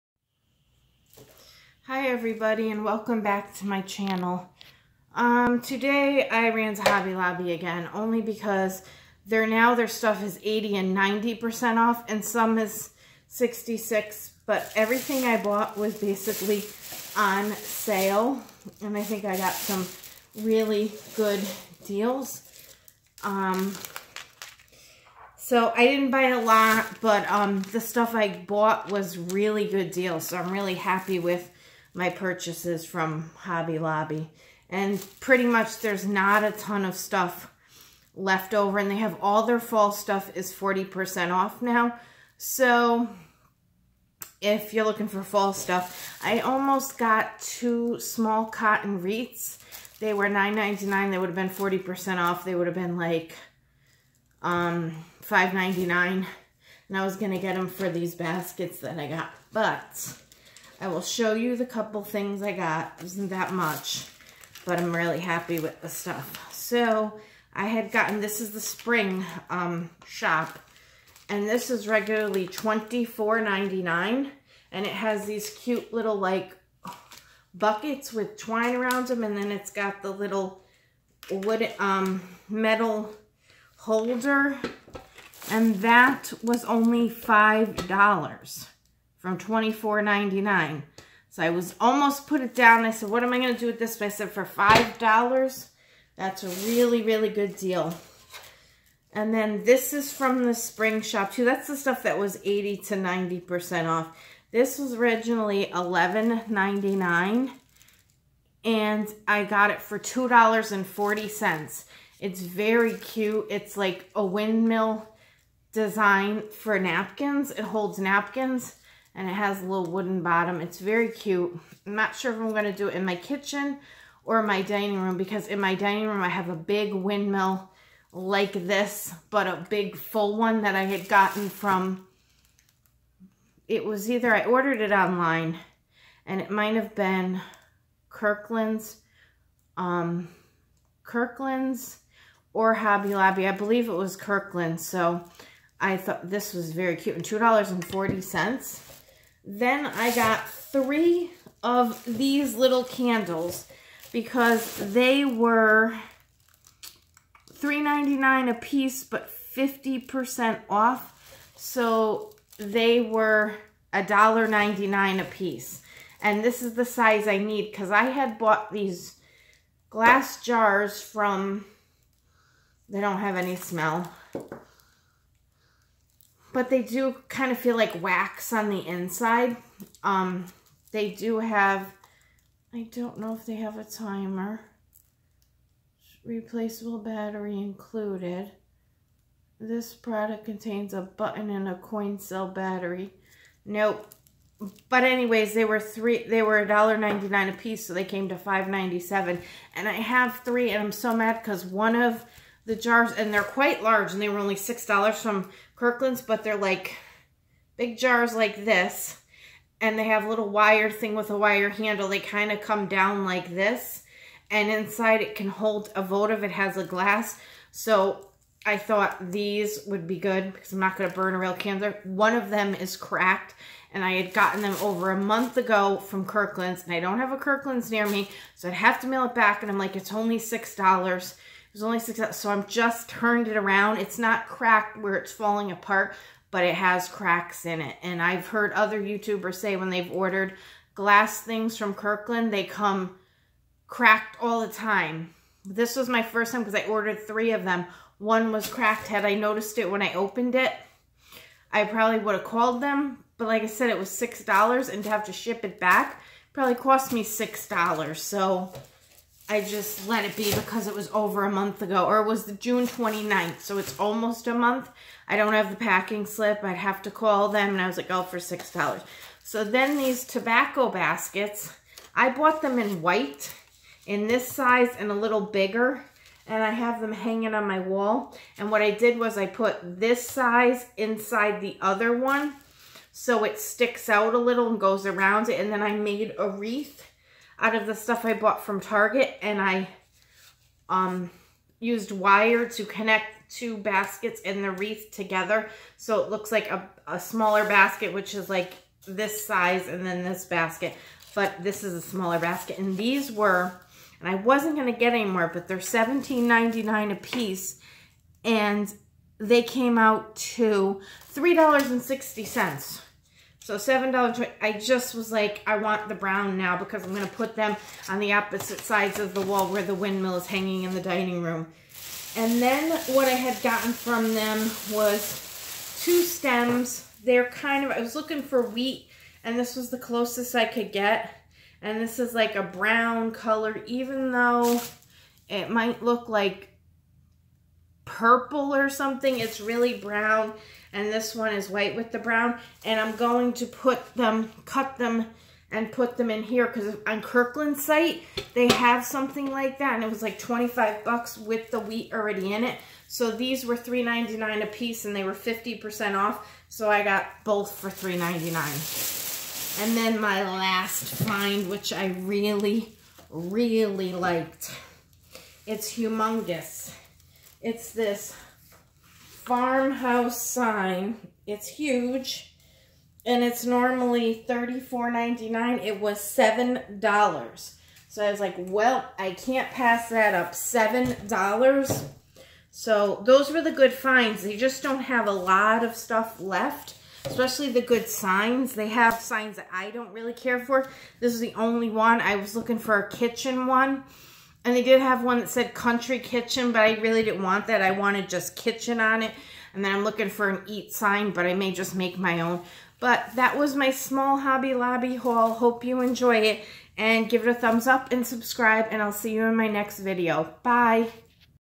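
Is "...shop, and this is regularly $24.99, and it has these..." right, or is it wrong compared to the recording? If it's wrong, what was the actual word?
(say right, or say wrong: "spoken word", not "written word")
right.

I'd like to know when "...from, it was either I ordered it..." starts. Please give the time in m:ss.
2:11.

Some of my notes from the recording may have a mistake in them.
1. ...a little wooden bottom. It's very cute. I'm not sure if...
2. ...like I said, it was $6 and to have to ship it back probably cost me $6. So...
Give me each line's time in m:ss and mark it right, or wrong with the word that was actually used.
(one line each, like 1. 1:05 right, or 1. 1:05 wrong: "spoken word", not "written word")
1. 1:59 right
2. 4:13 right.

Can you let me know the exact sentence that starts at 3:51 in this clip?
There's only six, so I'm just turned it around.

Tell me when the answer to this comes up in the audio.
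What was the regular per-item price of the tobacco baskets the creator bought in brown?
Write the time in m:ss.
5:05.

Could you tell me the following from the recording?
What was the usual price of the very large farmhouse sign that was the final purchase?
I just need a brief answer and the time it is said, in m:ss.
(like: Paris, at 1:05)
$34.99, at 6:14.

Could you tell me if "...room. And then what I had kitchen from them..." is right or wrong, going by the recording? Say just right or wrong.
wrong.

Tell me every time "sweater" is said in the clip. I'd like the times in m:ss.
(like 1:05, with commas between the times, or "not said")
not said.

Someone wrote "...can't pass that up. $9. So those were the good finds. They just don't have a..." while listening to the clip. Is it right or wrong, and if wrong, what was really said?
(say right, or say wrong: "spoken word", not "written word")
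wrong: "7", not "9".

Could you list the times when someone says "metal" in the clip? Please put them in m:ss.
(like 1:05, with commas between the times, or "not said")
1:22.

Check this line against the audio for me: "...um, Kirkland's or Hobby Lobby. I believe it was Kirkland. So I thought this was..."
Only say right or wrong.
right.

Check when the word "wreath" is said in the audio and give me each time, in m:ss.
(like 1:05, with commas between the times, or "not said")
0:49, 4:46, 4:54.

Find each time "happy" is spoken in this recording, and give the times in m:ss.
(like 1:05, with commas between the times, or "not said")
0:30, 1:05.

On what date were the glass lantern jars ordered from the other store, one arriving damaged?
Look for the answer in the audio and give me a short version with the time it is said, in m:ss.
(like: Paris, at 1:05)
June 29th, at 4:22.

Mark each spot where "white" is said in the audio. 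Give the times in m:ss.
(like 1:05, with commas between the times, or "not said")
4:33, 5:41.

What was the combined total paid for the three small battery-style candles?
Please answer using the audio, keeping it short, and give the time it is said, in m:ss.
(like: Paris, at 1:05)
$5.97, at 3:18.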